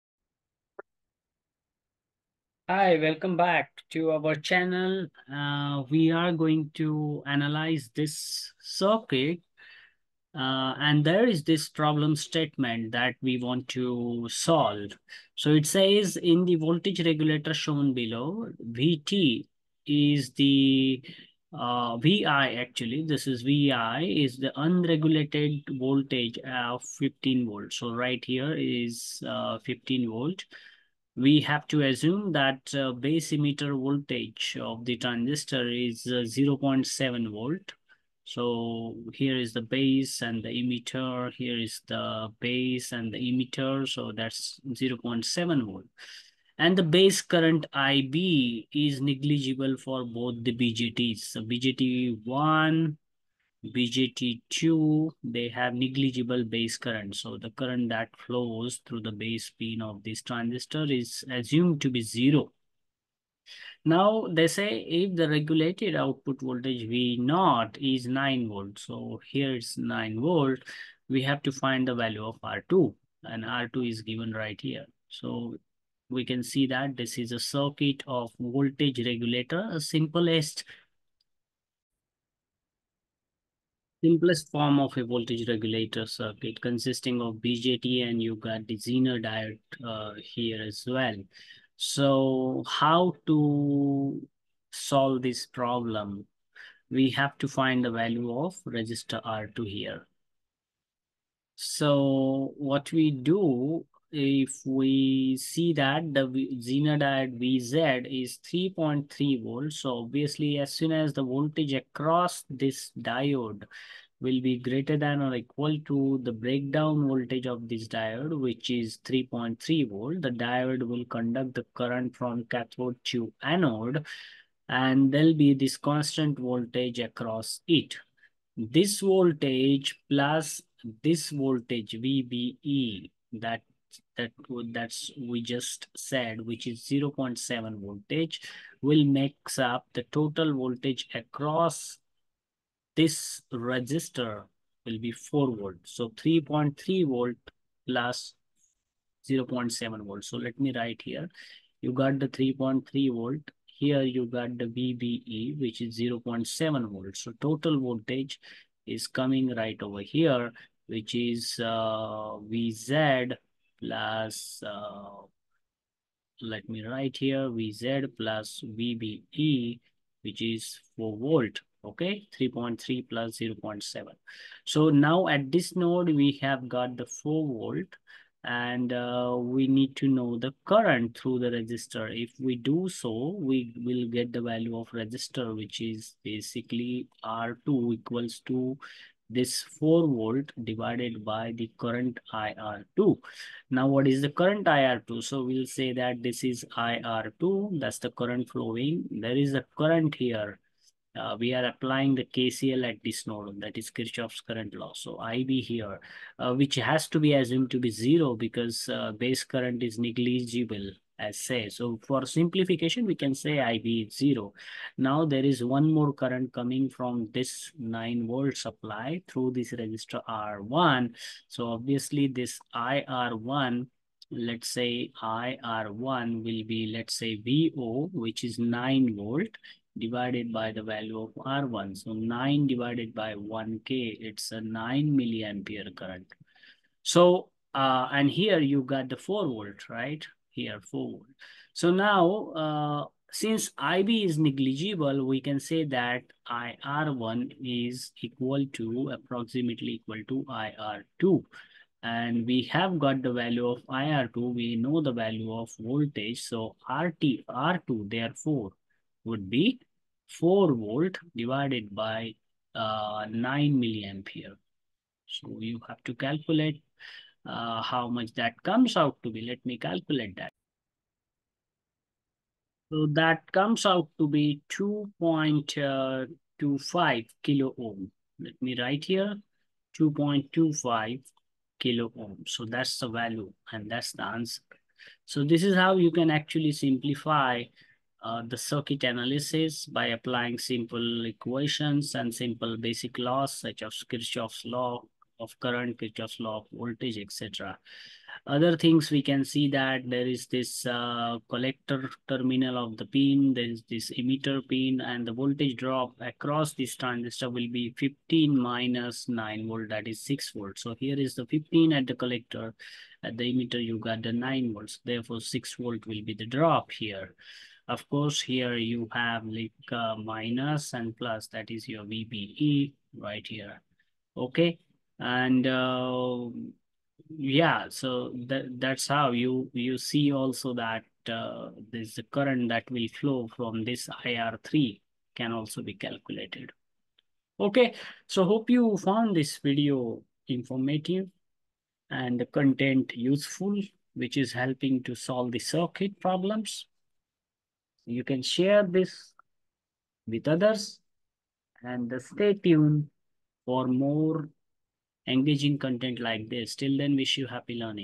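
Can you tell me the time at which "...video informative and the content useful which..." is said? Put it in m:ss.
5:39.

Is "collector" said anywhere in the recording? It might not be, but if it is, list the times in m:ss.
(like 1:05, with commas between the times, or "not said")
5:01, 5:12.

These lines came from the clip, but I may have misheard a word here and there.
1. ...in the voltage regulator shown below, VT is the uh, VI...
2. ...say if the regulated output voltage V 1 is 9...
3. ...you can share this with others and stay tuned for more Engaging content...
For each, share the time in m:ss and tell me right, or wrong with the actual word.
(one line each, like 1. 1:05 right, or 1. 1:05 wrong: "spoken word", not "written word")
1. 0:16 right
2. 1:04 wrong: "0", not "1"
3. 5:48 right.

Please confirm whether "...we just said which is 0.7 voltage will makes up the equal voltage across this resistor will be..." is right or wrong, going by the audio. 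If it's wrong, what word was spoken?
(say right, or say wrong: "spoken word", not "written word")
wrong: "total", not "equal".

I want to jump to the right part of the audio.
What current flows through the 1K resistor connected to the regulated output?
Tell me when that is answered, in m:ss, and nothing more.
3:54.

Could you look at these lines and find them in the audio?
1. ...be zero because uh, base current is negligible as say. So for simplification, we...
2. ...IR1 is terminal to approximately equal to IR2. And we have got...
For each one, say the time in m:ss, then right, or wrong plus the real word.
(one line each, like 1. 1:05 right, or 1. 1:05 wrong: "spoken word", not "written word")
1. 3:27 right
2. 4:06 wrong: "equal", not "terminal".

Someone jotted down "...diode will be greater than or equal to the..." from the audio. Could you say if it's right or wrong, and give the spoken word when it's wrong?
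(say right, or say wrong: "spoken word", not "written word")
right.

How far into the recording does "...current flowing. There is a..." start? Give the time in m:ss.
3:18.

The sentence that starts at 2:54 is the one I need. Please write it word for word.
So now at this node, we have got the 4 volt and uh, we need to know the current through the resistor.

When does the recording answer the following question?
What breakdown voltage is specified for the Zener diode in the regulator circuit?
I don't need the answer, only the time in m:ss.
1:48.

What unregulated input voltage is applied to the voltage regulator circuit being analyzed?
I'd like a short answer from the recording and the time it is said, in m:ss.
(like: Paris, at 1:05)
15 volts, at 0:26.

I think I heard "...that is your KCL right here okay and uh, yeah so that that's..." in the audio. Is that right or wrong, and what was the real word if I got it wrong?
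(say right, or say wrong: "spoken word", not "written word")
wrong: "VBE", not "KCL".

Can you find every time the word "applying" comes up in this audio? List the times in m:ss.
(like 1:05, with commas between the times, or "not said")
3:21, 4:50.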